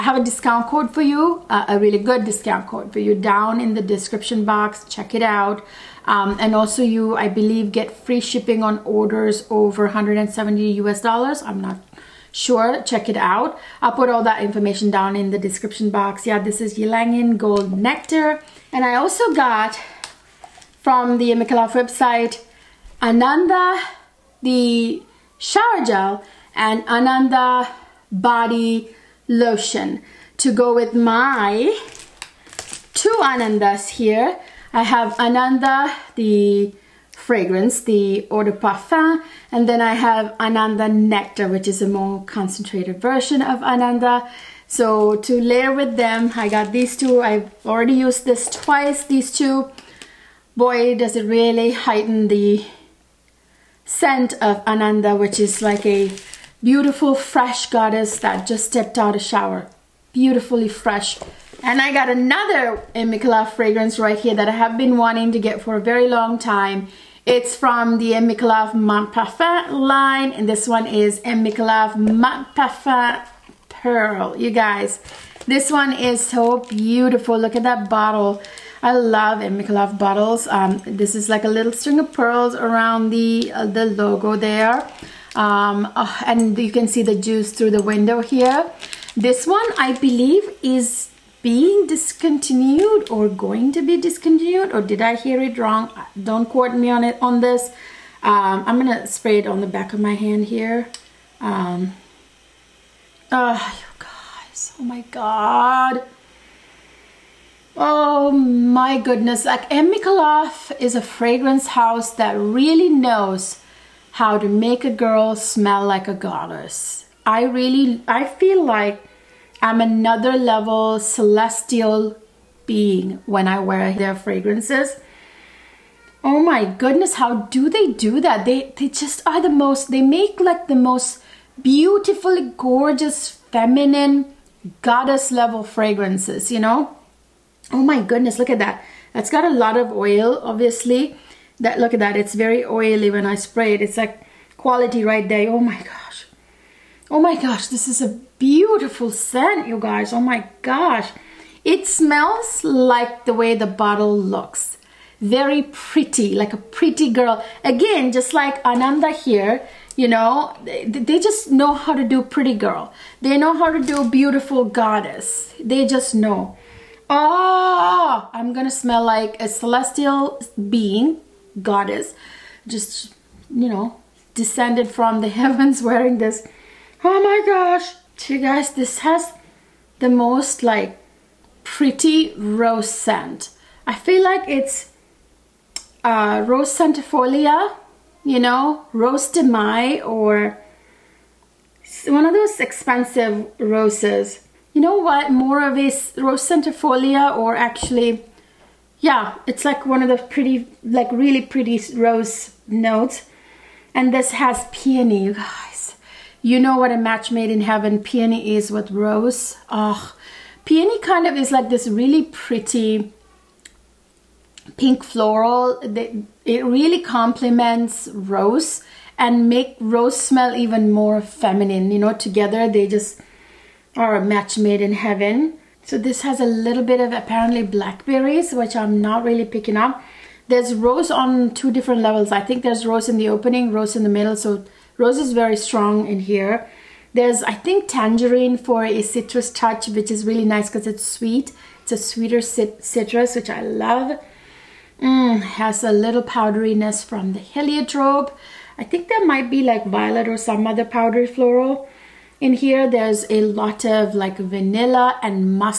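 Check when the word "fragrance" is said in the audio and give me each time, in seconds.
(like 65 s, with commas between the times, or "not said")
37 s, 63 s, 111 s, 124 s, 135 s.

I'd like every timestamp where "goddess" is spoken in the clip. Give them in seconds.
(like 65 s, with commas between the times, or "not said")
57 s, 116 s, 134 s, 164 s, 171 s.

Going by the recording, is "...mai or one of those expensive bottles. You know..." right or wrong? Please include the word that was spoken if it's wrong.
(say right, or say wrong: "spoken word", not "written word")
wrong: "roses", not "bottles".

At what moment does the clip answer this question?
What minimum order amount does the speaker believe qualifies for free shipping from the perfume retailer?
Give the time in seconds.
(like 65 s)
9 s.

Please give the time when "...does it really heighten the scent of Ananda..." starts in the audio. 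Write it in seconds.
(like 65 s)
50 s.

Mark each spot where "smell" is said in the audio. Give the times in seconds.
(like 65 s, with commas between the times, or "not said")
115 s, 151 s, 168 s, 220 s.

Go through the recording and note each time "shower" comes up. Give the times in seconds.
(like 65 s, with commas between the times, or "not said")
25 s, 59 s.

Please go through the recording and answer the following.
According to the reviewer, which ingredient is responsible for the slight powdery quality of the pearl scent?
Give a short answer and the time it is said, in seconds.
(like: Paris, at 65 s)
Heliotrope, at 247 s.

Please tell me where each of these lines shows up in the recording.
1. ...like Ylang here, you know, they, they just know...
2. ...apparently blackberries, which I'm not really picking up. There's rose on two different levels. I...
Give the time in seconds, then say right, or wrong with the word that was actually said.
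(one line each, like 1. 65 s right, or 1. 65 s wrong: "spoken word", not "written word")
1. 158 s wrong: "Ananda", not "Ylang"
2. 227 s right.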